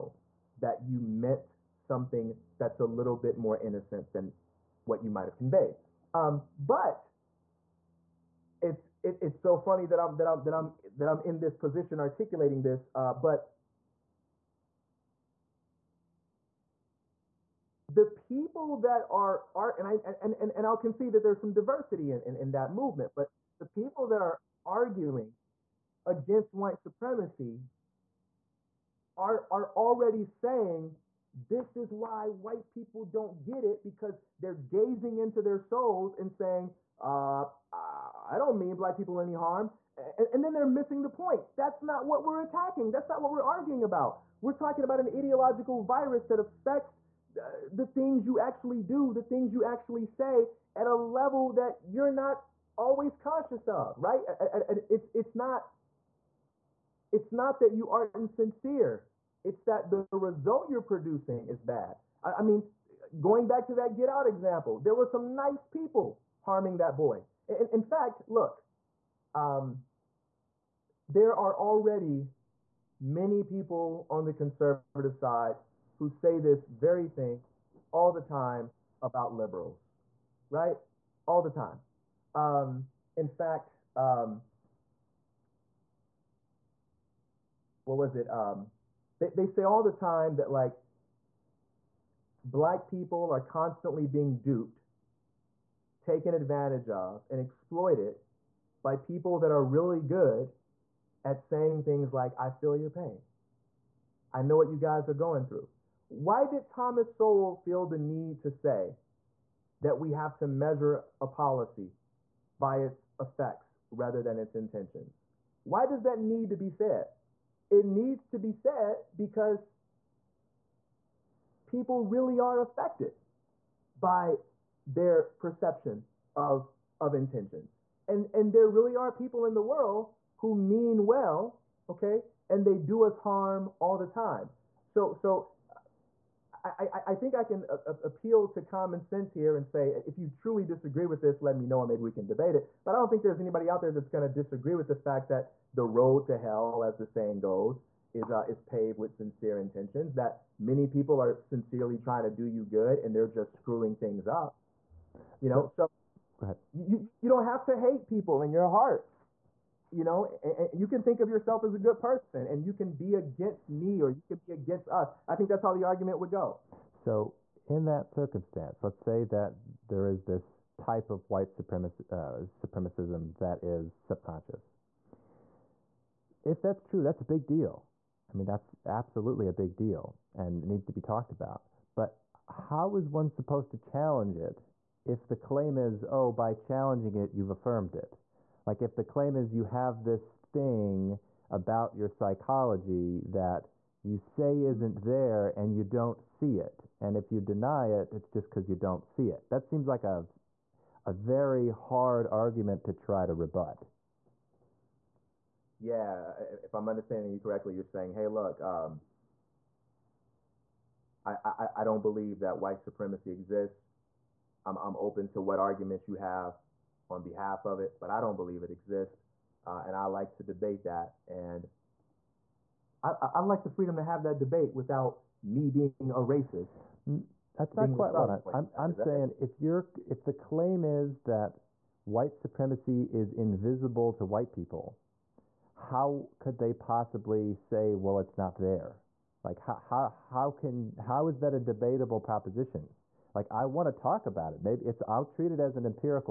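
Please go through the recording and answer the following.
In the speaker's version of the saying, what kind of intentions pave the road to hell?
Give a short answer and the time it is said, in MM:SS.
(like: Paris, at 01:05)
sincere intentions, at 02:29.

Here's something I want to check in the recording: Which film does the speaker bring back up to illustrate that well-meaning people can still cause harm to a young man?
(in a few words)
Get Out.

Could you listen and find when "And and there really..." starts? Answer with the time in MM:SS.
02:08.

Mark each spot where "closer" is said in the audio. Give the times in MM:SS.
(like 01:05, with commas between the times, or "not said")
not said.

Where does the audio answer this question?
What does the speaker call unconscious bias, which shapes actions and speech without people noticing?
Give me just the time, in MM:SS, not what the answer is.
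00:45.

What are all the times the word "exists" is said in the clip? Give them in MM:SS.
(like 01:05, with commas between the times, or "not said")
03:33, 03:38.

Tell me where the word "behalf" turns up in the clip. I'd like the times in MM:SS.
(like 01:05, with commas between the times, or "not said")
03:37.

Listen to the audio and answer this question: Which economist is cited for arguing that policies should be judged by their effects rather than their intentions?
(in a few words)
Thomas Sowell.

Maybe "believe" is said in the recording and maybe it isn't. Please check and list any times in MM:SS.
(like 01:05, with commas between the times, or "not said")
03:32, 03:38.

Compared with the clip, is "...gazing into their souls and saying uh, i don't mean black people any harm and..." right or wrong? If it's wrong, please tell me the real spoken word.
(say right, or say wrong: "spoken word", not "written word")
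right.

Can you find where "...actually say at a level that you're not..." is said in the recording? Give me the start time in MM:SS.
00:49.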